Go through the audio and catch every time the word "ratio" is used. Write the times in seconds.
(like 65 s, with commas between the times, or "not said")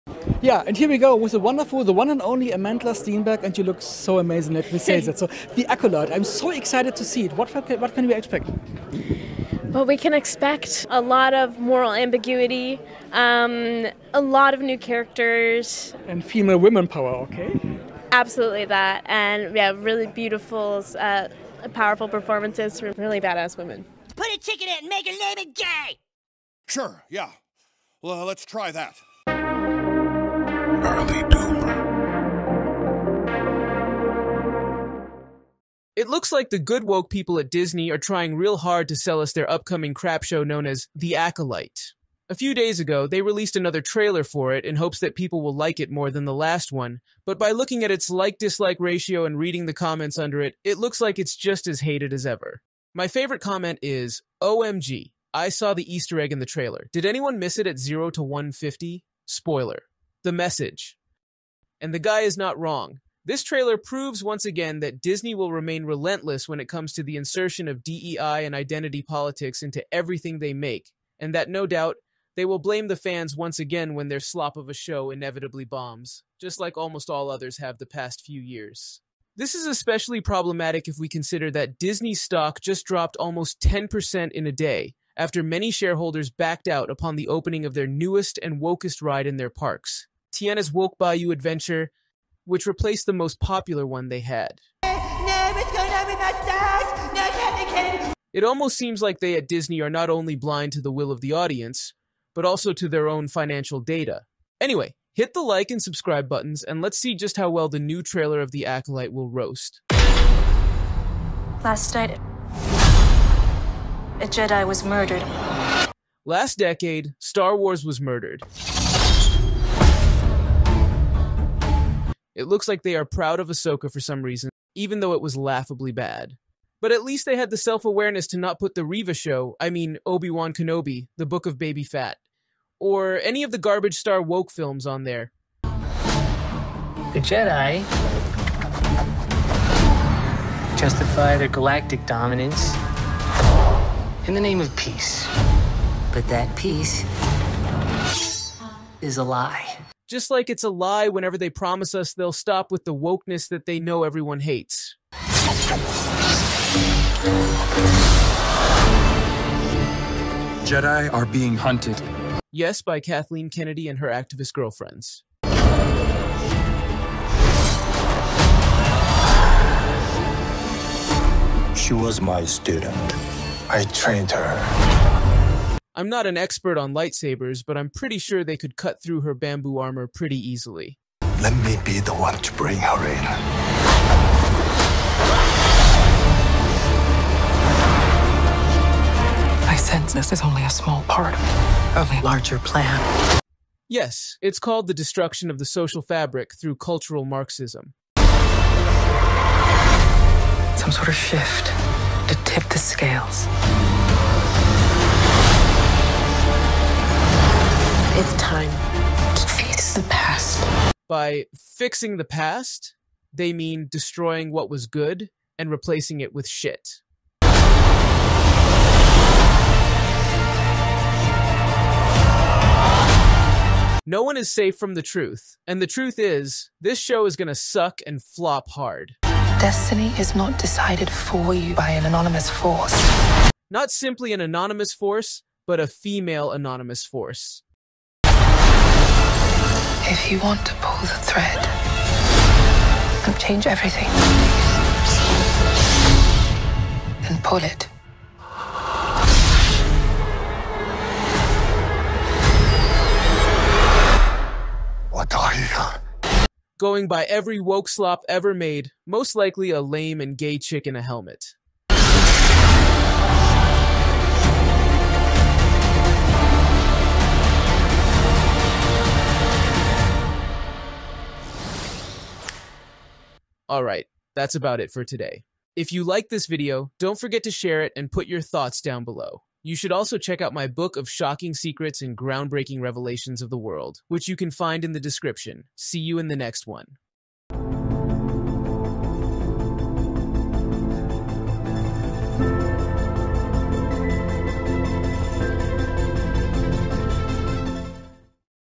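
48 s.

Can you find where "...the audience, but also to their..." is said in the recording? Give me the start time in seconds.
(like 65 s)
101 s.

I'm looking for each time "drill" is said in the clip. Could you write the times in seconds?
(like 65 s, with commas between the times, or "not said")
not said.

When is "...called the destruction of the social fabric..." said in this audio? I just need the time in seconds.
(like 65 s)
194 s.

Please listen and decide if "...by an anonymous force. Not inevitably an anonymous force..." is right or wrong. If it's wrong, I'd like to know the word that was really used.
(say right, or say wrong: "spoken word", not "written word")
wrong: "simply", not "inevitably".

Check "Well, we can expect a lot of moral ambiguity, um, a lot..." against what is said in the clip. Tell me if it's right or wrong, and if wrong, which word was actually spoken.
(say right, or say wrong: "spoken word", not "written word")
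right.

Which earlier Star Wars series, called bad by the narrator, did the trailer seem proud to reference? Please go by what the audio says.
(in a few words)
Ahsoka.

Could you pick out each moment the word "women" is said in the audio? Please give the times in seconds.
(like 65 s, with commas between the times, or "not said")
16 s, 23 s.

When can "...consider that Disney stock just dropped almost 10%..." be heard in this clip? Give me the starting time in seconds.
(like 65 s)
81 s.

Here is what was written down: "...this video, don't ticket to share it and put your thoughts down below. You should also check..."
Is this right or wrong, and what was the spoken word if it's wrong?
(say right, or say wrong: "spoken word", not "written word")
wrong: "forget", not "ticket".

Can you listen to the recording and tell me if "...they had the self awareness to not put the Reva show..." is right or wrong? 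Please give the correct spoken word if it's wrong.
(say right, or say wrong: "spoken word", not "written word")
right.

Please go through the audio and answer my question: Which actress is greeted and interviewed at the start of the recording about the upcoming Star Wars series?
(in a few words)
Amandla Stenberg.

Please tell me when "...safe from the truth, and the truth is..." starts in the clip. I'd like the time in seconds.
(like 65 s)
224 s.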